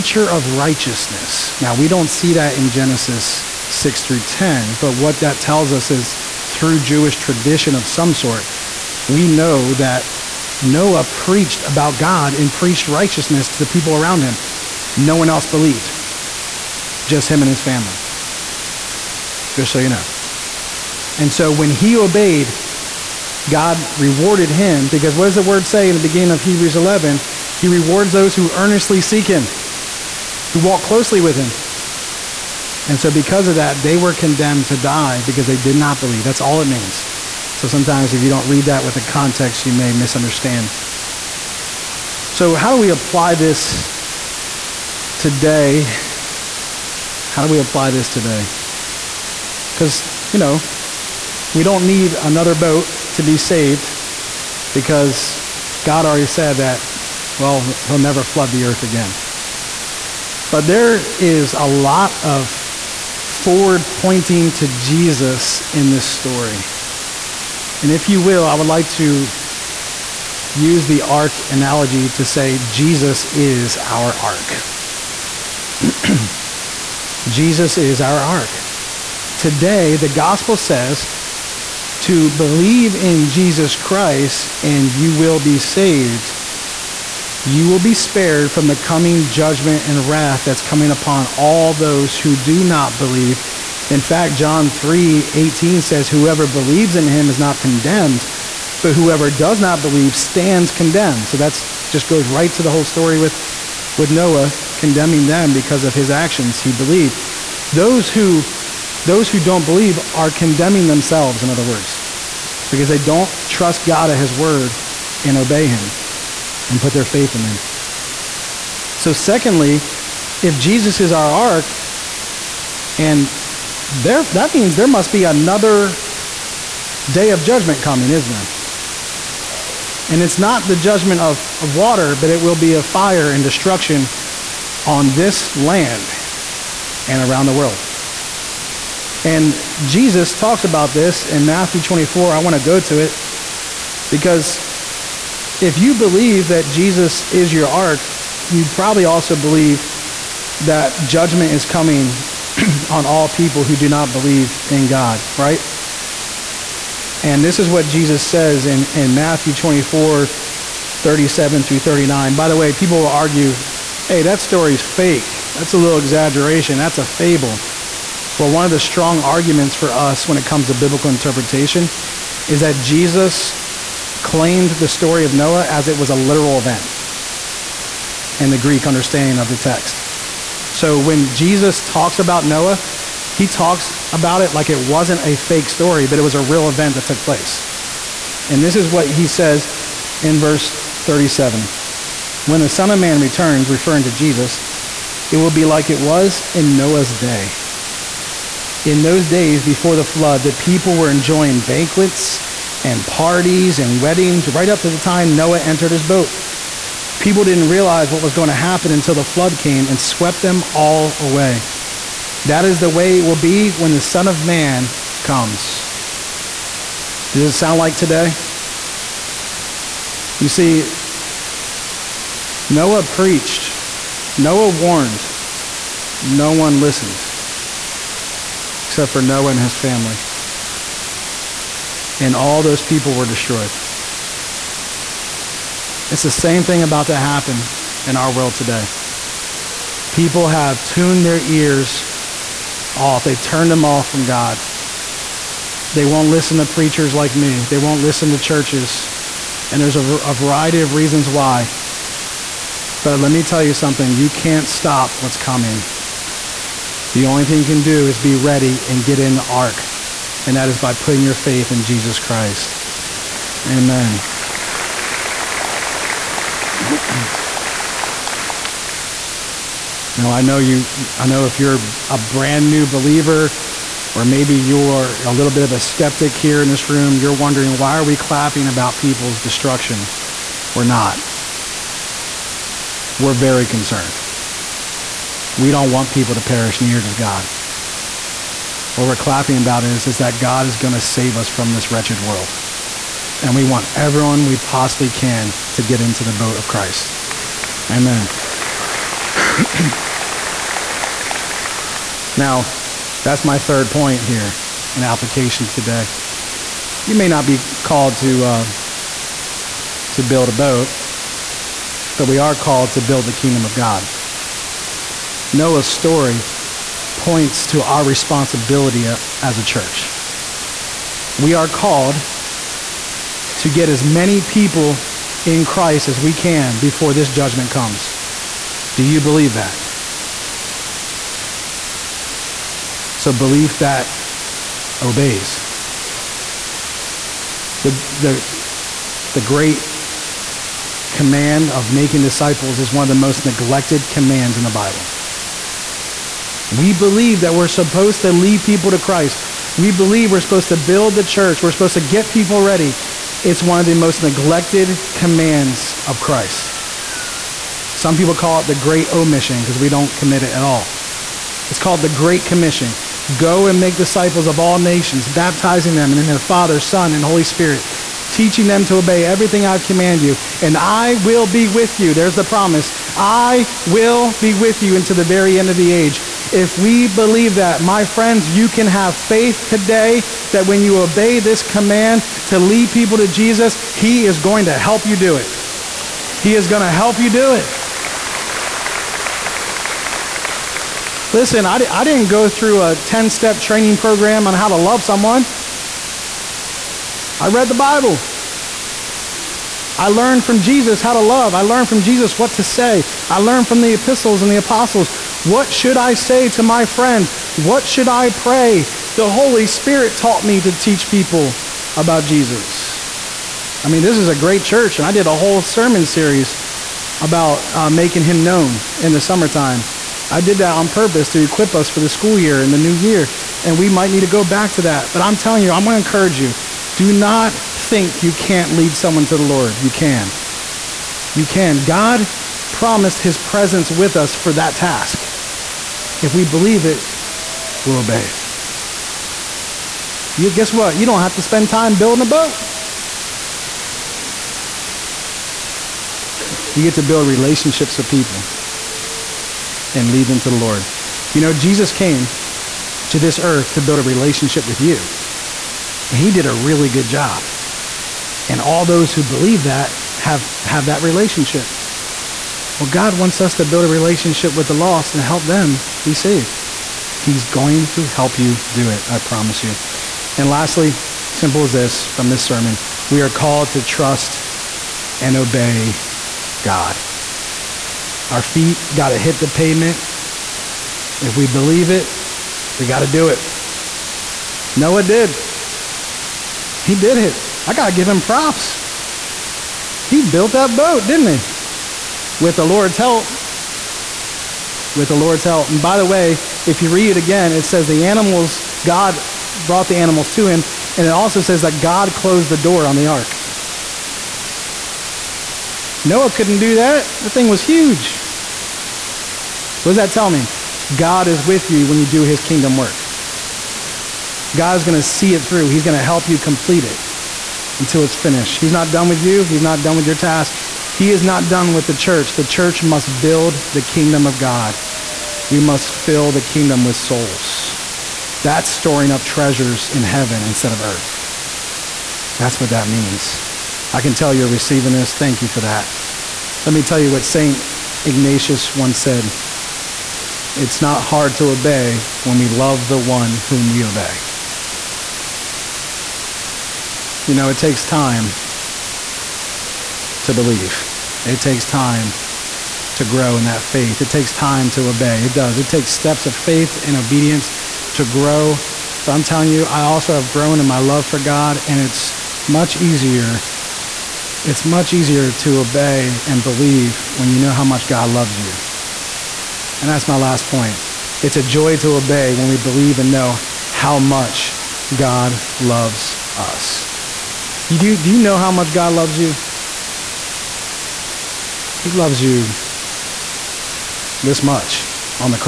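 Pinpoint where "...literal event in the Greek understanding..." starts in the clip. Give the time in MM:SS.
02:56.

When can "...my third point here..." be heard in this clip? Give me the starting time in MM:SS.
05:03.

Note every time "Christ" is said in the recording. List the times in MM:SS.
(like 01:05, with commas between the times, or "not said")
01:23, 04:22, 04:56, 05:25, 05:48, 05:56.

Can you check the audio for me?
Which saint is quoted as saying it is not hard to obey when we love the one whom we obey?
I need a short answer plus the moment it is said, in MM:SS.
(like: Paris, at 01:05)
St. Ignatius, at 08:57.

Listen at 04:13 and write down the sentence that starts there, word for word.
But let me tell you something you can't stop what's coming.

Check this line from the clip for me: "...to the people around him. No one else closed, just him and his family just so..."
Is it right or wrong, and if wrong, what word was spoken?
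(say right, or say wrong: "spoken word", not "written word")
wrong: "believed", not "closed".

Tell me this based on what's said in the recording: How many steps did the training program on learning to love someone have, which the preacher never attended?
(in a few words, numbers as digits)
10.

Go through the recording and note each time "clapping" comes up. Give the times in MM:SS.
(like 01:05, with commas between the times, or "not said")
04:38, 04:49.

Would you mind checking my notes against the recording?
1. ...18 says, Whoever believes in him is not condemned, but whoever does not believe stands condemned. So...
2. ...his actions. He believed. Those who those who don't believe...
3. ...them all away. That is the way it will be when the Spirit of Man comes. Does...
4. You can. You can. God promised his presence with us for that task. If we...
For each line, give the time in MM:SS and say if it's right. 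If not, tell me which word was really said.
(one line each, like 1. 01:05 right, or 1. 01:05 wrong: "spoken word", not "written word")
1. 01:35 right
2. 01:45 right
3. 03:30 wrong: "Son", not "Spirit"
4. 07:09 right.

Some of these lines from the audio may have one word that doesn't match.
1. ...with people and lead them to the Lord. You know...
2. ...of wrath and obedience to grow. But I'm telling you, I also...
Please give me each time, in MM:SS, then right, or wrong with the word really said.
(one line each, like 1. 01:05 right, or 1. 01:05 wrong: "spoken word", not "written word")
1. 07:27 right
2. 09:16 wrong: "faith", not "wrath".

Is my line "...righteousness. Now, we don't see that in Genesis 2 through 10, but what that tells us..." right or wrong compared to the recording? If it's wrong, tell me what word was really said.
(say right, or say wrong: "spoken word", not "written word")
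wrong: "6", not "2".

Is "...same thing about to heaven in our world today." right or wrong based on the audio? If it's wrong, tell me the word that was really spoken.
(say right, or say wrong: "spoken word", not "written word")
wrong: "happen", not "heaven".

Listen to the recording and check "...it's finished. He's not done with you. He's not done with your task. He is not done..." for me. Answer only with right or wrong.
right.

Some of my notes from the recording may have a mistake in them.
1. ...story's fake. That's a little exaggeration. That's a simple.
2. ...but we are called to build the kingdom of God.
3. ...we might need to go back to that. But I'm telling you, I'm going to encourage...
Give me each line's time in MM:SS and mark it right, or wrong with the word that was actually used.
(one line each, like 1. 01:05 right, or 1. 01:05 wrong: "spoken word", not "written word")
1. 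02:44 wrong: "fable", not "simple"
2. 05:12 right
3. 07:03 right.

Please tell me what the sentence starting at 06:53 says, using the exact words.
I mean, this is a great church, and I did a whole sermon series about uh, making him known in the summertime.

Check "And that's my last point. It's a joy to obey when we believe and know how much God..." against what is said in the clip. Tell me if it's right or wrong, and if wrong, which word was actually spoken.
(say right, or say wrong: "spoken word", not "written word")
right.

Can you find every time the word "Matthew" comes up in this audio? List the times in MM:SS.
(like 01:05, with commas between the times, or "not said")
02:21, 02:39.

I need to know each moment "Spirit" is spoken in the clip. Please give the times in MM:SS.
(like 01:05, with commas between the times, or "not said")
06:07, 06:49.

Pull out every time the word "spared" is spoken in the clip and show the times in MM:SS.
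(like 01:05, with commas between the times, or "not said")
01:27.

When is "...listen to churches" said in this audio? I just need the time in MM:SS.
04:08.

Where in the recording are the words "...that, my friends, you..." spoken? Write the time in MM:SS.
06:17.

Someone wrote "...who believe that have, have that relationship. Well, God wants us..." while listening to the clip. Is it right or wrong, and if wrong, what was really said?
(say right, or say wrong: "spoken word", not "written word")
right.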